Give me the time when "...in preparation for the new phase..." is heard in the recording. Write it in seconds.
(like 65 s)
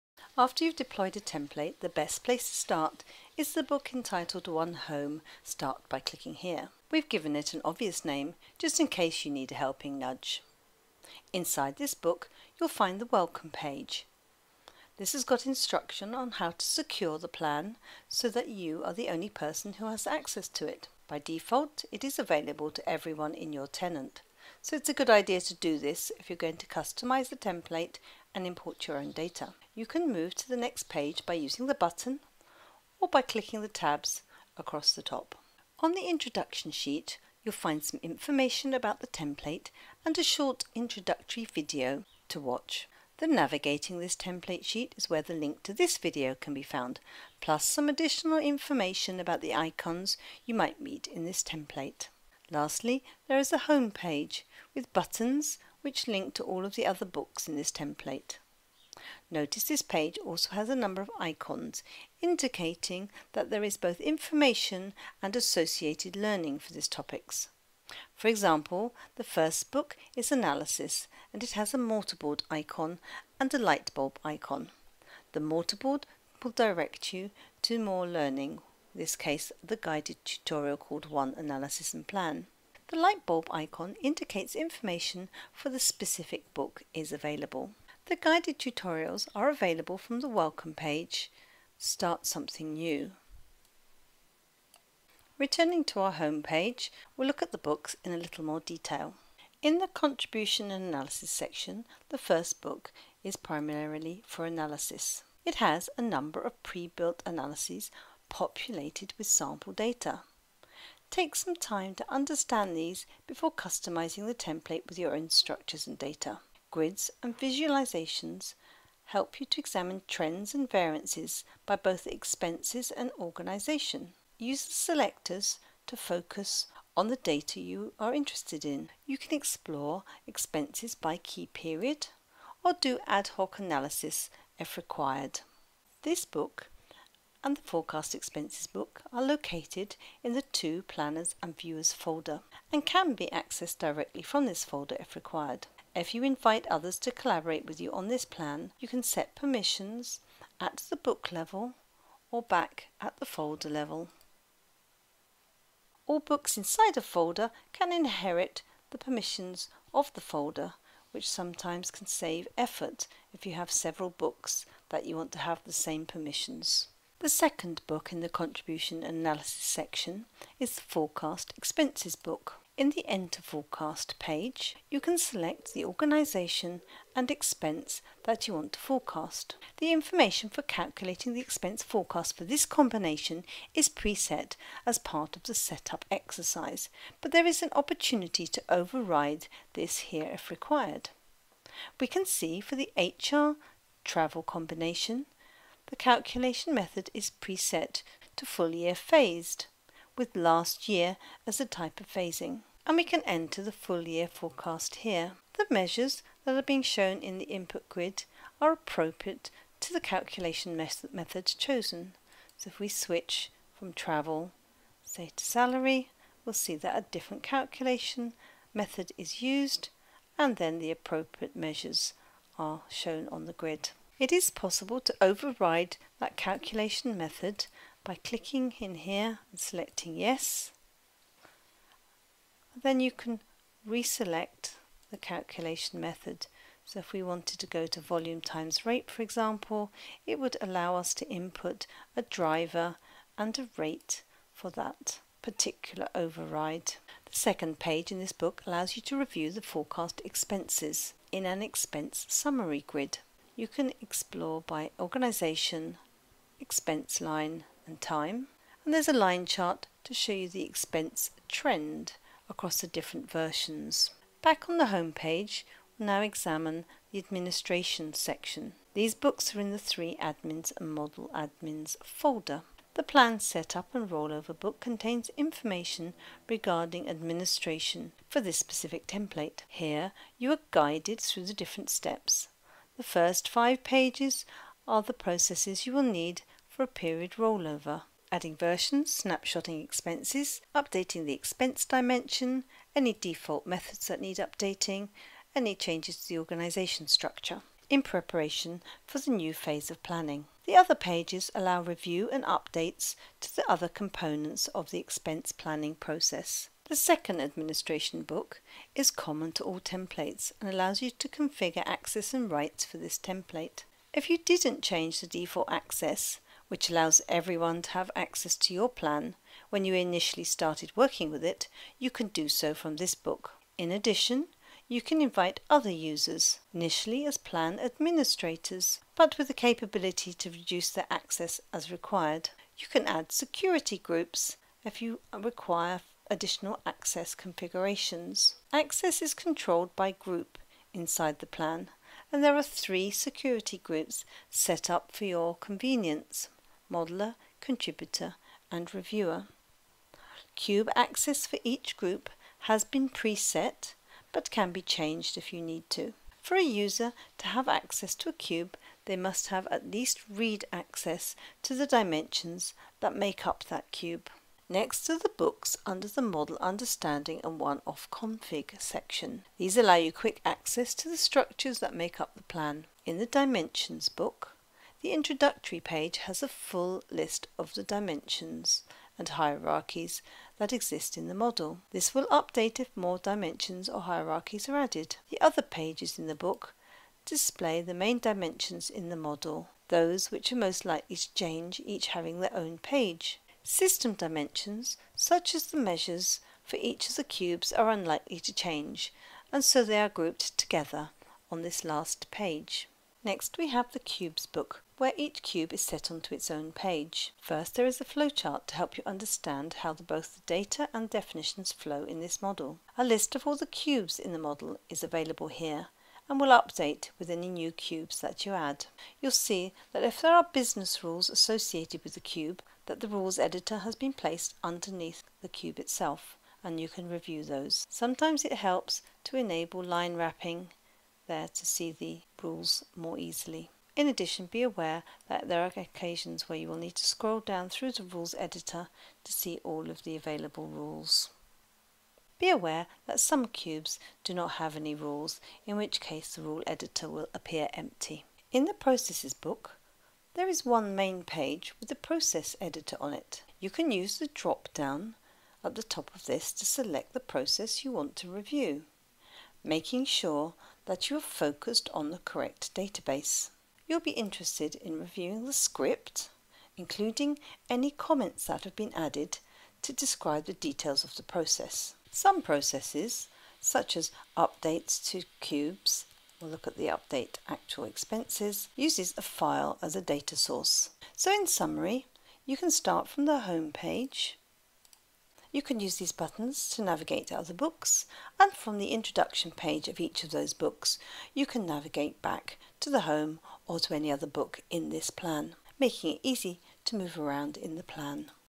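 297 s.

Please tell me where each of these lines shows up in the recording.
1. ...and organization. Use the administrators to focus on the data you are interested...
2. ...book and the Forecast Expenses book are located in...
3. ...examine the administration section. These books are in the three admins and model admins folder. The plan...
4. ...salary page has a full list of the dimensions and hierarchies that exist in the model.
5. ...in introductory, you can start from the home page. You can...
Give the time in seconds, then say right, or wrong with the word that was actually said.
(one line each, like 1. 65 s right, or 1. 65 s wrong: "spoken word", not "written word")
1. 122 s wrong: "selectors", not "administrators"
2. 136 s right
3. 266 s right
4. 375 s wrong: "introductory", not "salary"
5. 481 s wrong: "summary", not "introductory".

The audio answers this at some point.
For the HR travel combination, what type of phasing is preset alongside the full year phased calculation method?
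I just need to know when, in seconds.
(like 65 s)
200 s.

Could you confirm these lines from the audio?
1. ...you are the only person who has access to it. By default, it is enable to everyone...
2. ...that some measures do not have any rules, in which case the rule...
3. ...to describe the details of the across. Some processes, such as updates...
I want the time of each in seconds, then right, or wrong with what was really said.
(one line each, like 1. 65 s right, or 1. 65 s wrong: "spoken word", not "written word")
1. 18 s wrong: "available", not "enable"
2. 443 s wrong: "cubes", not "measures"
3. 469 s wrong: "process", not "across".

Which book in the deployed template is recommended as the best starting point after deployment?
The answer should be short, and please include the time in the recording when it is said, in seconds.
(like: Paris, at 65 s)
One Home, at 4 s.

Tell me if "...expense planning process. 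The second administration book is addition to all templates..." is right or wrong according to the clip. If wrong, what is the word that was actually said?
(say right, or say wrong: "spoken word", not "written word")
wrong: "common", not "addition".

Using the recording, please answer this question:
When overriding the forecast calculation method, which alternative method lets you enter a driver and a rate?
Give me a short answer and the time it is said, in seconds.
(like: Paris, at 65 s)
volume times rate, at 237 s.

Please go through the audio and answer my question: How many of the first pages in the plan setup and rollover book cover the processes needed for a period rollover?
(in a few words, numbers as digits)
5.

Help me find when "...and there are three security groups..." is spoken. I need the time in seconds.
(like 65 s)
342 s.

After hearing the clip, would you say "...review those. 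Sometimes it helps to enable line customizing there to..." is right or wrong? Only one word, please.
wrong.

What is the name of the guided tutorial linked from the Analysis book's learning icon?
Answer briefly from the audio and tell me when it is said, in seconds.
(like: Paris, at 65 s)
One Analysis and Plan, at 81 s.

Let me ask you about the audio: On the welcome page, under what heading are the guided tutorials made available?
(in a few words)
Start Something New.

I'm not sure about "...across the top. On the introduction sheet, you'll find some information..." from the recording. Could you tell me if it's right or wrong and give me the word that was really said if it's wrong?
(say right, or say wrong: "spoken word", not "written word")
right.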